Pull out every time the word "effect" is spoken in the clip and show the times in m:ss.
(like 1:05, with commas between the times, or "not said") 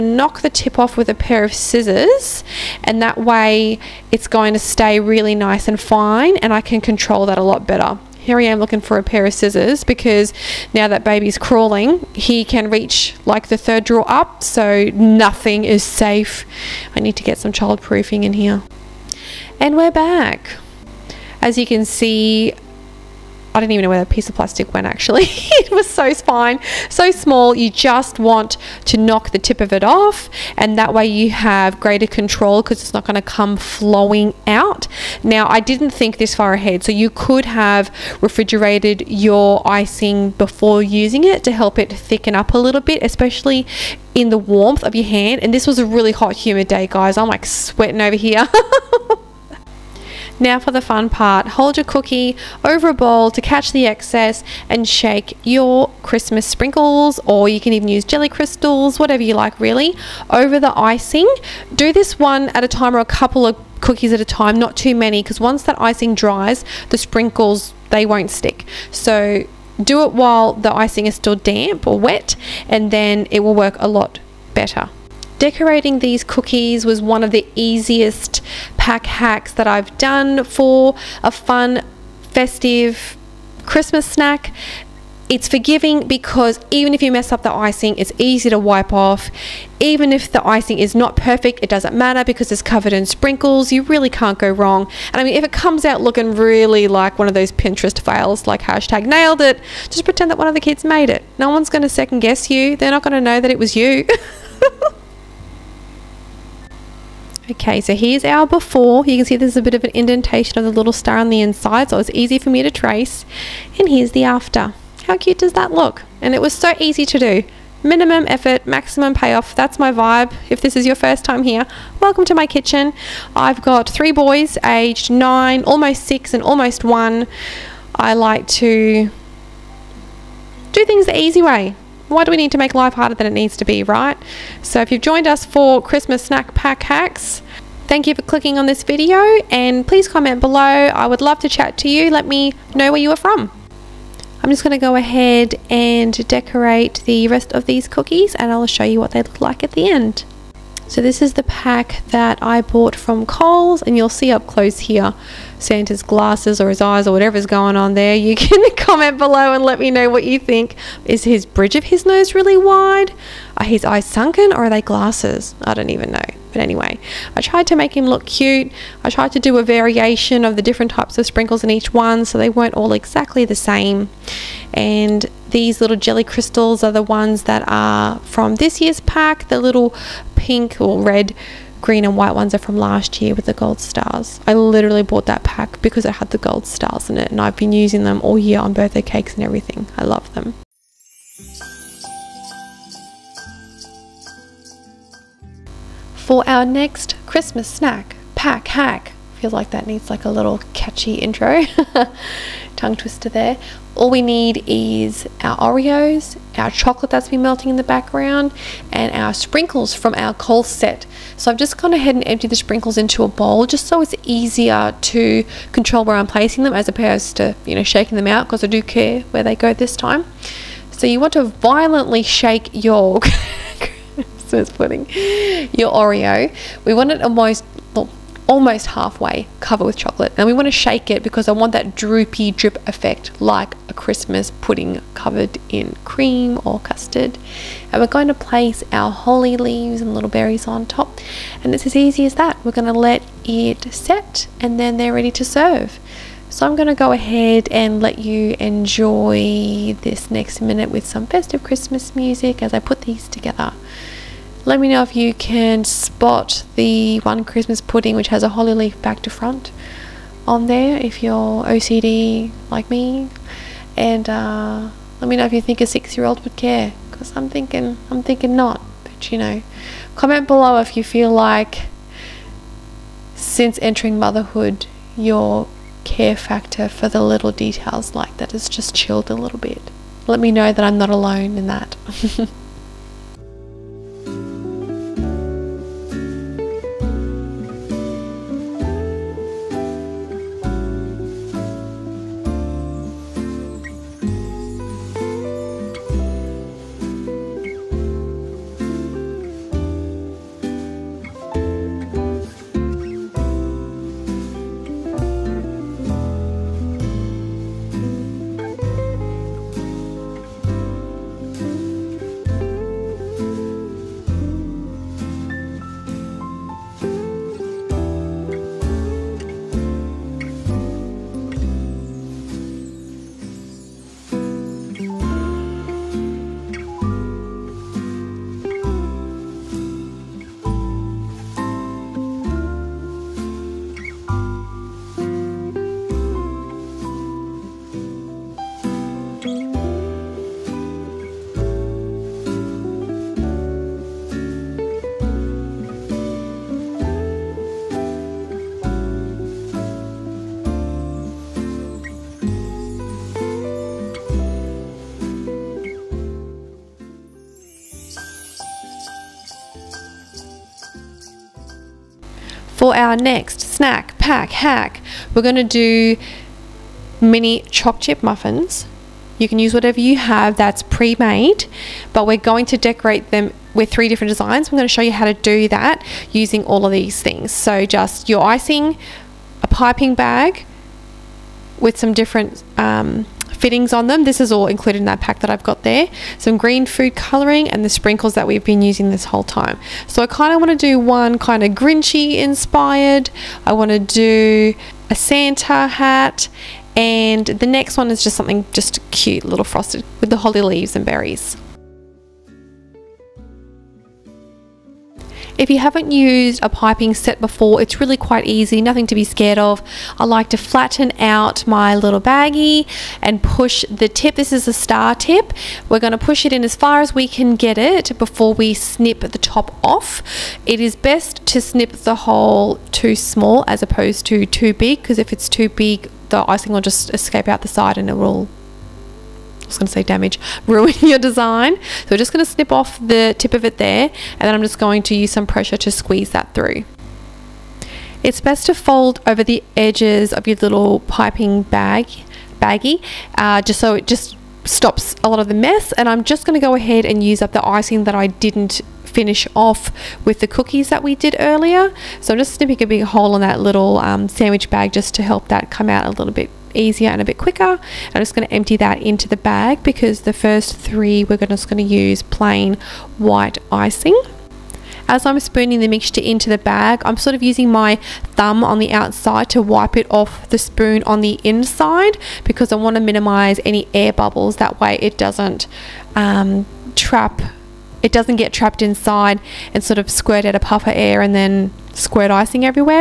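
3:52.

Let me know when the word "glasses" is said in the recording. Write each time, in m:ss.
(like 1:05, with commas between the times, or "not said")
2:36, 2:44.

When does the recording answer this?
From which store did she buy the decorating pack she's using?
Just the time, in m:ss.
2:33.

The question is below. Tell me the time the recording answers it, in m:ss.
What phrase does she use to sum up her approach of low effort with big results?
1:57.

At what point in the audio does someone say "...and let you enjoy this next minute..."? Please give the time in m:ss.
4:07.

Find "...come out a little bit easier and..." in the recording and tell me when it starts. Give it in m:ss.
7:35.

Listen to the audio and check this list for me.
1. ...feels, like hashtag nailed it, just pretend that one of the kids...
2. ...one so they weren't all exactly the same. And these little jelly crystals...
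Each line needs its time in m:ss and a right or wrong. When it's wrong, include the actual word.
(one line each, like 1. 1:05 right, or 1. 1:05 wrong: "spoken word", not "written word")
1. 1:38 wrong: "fails", not "feels"
2. 2:51 right.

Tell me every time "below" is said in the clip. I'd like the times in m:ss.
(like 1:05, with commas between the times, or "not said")
2:20, 2:39, 4:30.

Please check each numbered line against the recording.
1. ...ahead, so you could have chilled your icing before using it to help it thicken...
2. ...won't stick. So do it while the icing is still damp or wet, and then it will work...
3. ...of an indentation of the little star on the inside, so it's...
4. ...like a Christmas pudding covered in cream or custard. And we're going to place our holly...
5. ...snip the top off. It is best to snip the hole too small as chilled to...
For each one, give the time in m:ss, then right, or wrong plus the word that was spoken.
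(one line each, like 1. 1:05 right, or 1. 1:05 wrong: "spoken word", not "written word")
1. 0:36 wrong: "refrigerated", not "chilled"
2. 1:08 right
3. 1:49 right
4. 3:53 right
5. 6:58 wrong: "opposed", not "chilled".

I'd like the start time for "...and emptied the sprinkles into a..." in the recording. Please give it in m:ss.
3:32.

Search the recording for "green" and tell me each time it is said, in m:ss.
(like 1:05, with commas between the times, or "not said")
3:01, 6:26.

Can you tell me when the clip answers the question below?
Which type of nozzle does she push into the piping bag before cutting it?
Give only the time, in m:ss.
6:54.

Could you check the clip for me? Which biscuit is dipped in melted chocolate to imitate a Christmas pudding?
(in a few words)
Oreos.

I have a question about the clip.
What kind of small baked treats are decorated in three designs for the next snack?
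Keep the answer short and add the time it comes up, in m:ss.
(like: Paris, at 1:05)
Mini choc chip muffins, at 6:07.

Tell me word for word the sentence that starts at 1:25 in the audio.
It's forgiving because even if you mess up the icing, it's easy to wipe off.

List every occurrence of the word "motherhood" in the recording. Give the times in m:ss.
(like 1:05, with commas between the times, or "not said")
4:34.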